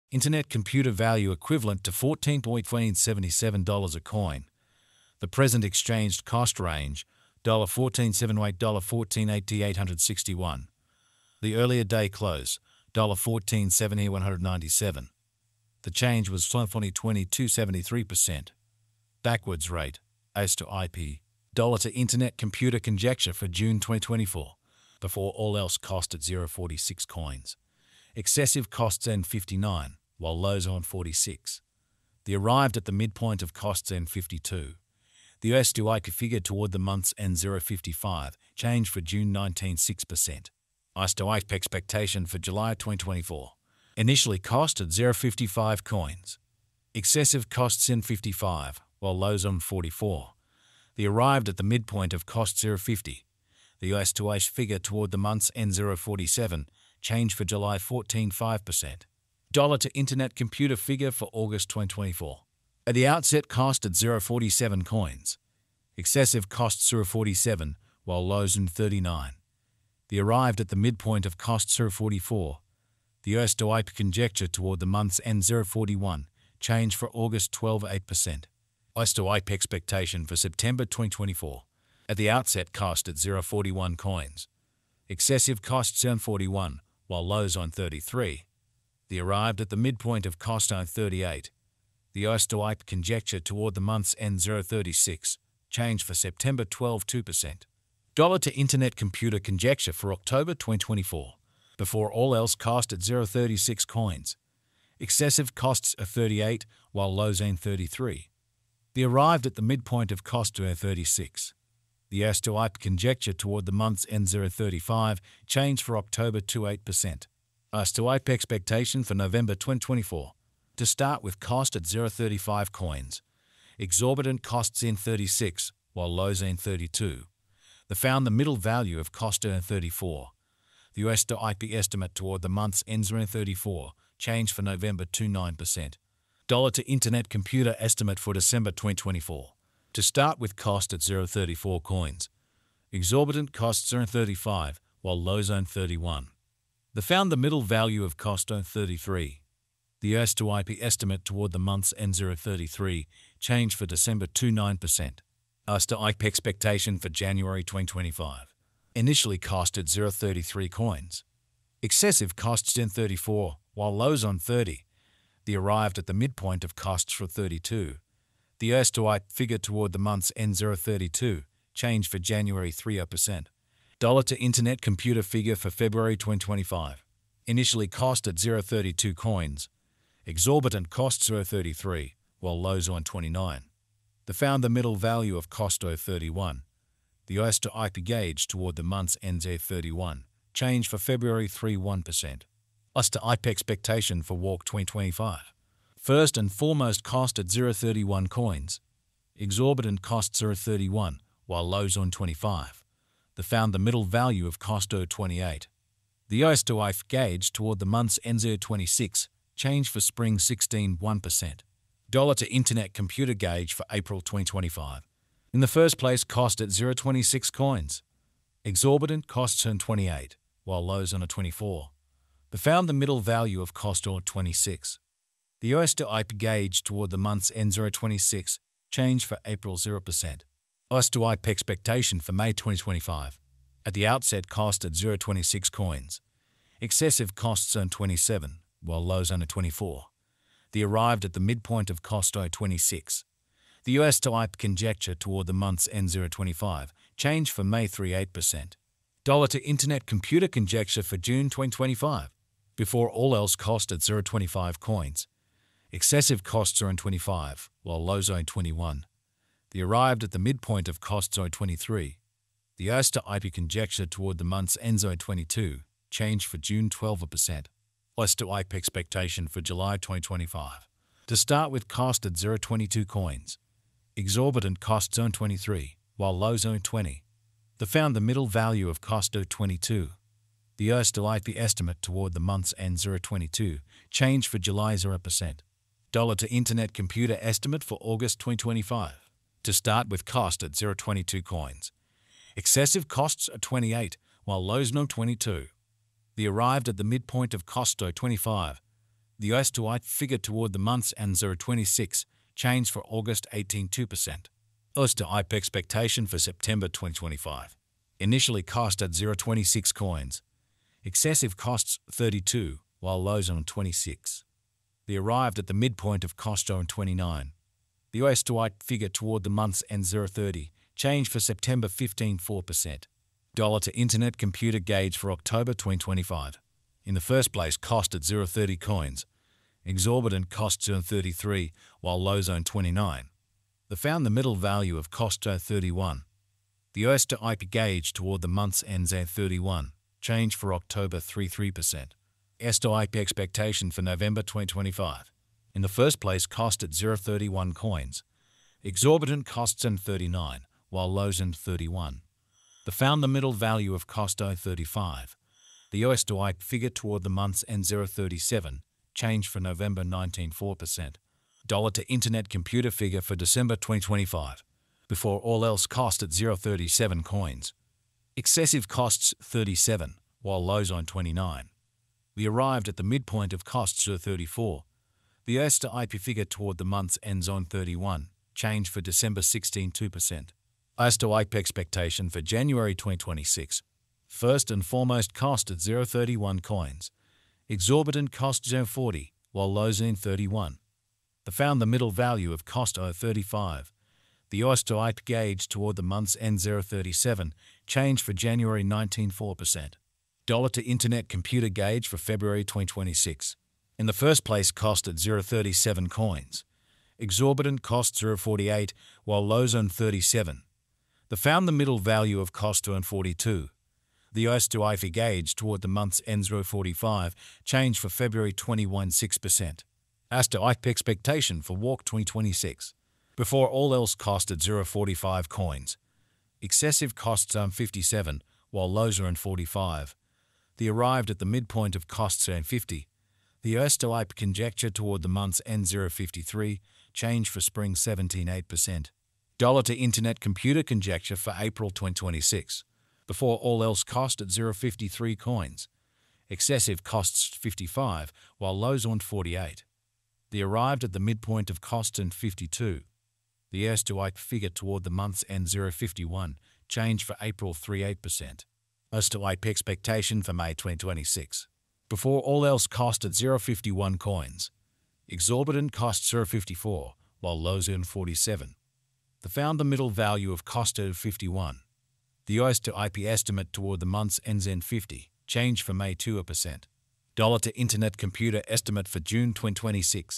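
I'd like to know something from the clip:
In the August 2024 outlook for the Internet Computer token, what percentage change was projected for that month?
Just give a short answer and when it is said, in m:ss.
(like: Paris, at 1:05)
12.8%, at 1:16.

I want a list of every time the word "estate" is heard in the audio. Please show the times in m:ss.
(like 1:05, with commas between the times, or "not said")
not said.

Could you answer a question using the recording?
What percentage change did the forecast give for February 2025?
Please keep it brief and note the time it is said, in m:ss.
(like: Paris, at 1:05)
3.1%, at 3:10.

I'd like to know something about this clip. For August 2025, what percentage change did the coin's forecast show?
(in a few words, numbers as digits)
18.2%.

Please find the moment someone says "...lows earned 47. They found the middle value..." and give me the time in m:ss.
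7:47.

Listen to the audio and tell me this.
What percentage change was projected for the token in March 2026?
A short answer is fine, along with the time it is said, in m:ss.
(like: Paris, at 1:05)
17.8%, at 7:17.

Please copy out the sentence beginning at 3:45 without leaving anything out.
The Oyster IPE gauge toward the month's N026 changed for April 0%.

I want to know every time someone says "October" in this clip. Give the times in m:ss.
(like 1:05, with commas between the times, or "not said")
1:40, 1:55, 5:25, 5:40.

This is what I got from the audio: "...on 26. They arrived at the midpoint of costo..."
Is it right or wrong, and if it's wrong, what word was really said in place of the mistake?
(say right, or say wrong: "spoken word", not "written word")
right.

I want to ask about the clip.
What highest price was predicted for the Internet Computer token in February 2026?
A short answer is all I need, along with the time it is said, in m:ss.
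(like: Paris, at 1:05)
0.48, at 6:47.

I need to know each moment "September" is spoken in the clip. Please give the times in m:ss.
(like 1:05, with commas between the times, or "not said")
1:20, 1:36, 5:06, 5:21.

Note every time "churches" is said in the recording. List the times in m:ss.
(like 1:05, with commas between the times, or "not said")
not said.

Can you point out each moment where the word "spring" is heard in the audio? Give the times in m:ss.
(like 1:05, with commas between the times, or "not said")
3:29, 7:17.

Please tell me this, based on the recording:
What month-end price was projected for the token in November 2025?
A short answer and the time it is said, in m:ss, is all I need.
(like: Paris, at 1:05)
0.37, at 5:56.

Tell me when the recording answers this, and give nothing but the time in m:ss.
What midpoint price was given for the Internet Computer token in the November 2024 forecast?
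2:07.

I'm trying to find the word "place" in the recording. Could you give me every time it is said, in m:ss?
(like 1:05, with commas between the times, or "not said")
3:35, 5:27, 5:46, 6:44.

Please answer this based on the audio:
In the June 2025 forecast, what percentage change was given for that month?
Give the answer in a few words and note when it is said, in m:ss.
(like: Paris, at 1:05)
12%, at 4:26.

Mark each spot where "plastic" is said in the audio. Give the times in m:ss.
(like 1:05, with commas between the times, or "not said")
not said.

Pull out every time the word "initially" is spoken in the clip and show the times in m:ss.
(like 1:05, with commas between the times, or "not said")
0:43, 2:38, 2:57, 5:08.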